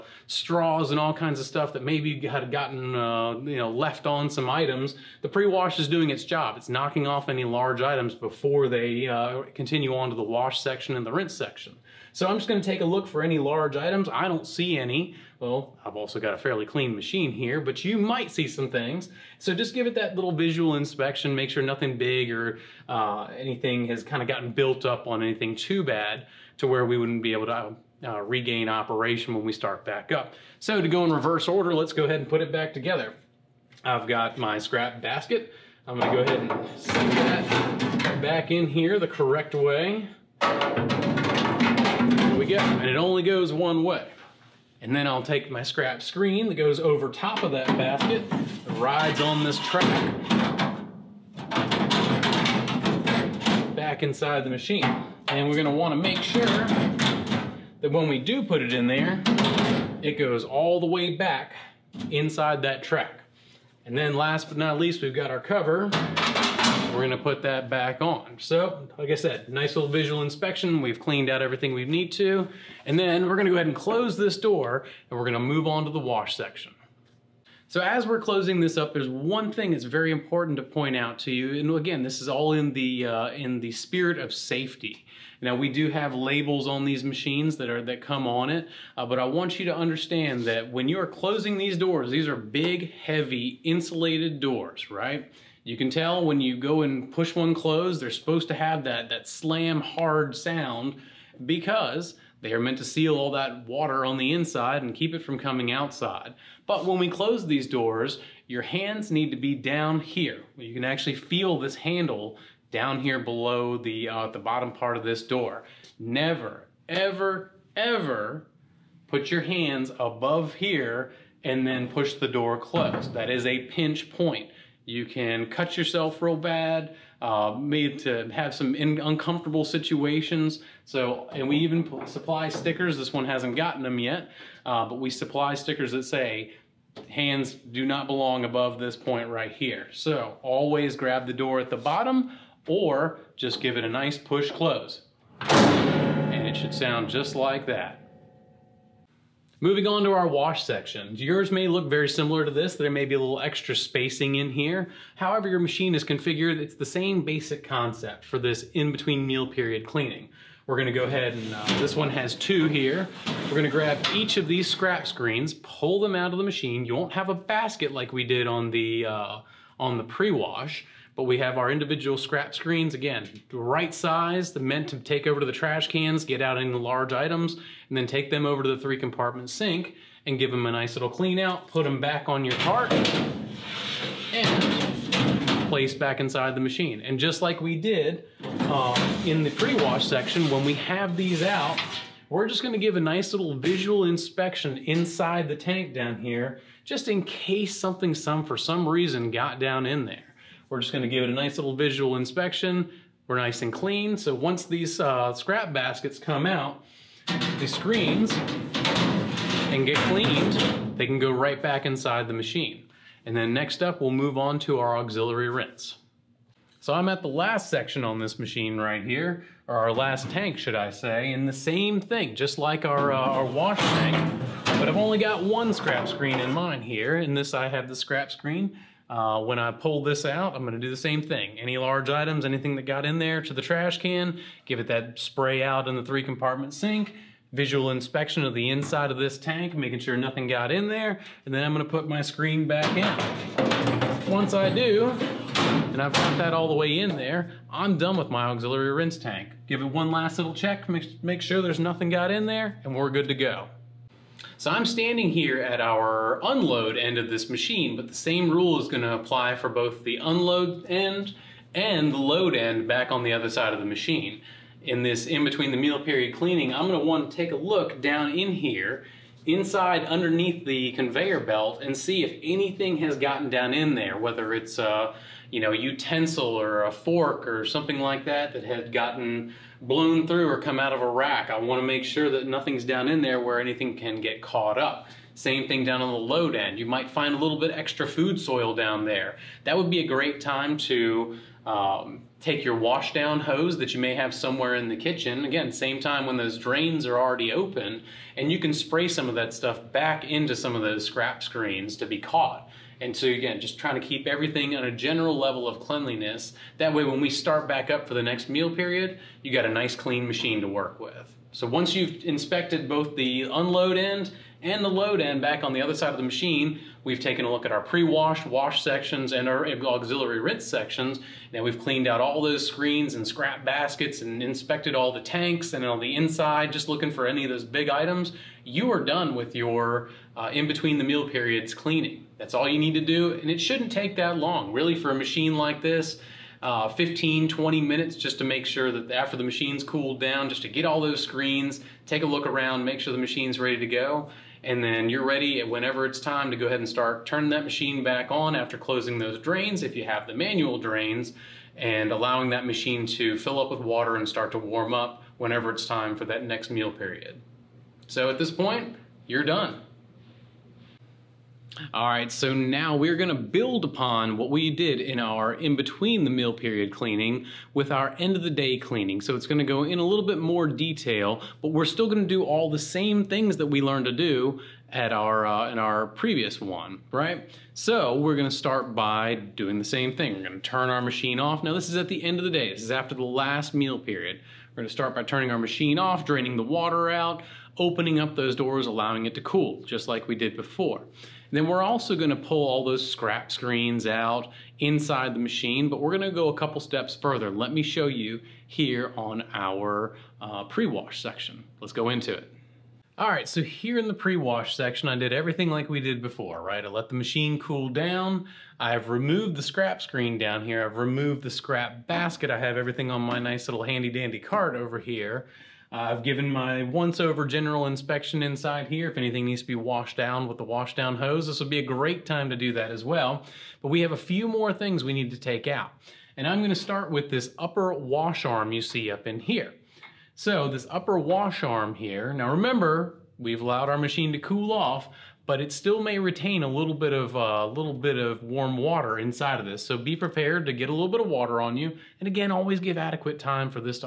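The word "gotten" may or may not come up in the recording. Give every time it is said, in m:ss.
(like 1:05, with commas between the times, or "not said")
0:02, 0:24, 2:13, 4:33, 4:38.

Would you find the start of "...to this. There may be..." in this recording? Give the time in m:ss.
2:32.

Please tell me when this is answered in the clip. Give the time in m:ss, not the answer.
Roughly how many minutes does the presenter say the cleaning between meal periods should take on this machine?
5:36.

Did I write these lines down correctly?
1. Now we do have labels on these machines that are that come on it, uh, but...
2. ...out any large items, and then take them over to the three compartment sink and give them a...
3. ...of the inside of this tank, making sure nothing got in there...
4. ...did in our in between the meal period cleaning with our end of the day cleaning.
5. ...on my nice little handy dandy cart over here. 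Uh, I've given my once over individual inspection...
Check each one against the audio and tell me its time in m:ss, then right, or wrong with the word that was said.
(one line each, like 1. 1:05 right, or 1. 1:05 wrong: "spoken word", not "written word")
1. 1:25 right
2. 2:56 right
3. 3:58 right
4. 6:04 right
5. 6:53 wrong: "general", not "individual".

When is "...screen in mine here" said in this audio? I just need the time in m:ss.
3:46.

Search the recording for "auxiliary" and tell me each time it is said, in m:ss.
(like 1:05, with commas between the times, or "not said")
3:34, 4:08, 5:19.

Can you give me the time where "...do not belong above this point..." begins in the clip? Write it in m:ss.
2:17.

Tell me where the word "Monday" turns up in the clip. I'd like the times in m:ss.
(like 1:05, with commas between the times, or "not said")
not said.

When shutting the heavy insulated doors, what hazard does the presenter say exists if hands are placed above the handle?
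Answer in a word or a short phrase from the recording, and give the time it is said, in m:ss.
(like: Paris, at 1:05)
Pinch point, at 2:03.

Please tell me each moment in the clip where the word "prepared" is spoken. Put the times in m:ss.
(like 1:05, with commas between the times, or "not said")
7:20.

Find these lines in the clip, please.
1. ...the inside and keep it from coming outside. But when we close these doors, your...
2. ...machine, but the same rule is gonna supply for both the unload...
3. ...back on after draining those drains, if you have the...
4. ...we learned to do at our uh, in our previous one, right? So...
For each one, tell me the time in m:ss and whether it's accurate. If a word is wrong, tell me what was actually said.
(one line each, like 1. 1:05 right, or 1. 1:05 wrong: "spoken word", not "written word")
1. 1:44 right
2. 4:17 wrong: "apply", not "supply"
3. 5:48 wrong: "closing", not "draining"
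4. 6:13 right.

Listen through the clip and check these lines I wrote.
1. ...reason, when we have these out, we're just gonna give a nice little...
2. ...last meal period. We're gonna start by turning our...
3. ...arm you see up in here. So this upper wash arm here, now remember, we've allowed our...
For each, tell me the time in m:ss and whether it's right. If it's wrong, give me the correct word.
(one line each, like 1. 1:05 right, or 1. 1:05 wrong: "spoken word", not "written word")
1. 3:10 wrong: "section", not "reason"
2. 6:23 right
3. 7:08 right.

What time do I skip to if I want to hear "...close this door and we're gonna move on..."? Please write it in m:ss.
1:13.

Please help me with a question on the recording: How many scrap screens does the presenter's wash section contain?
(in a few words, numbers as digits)
2.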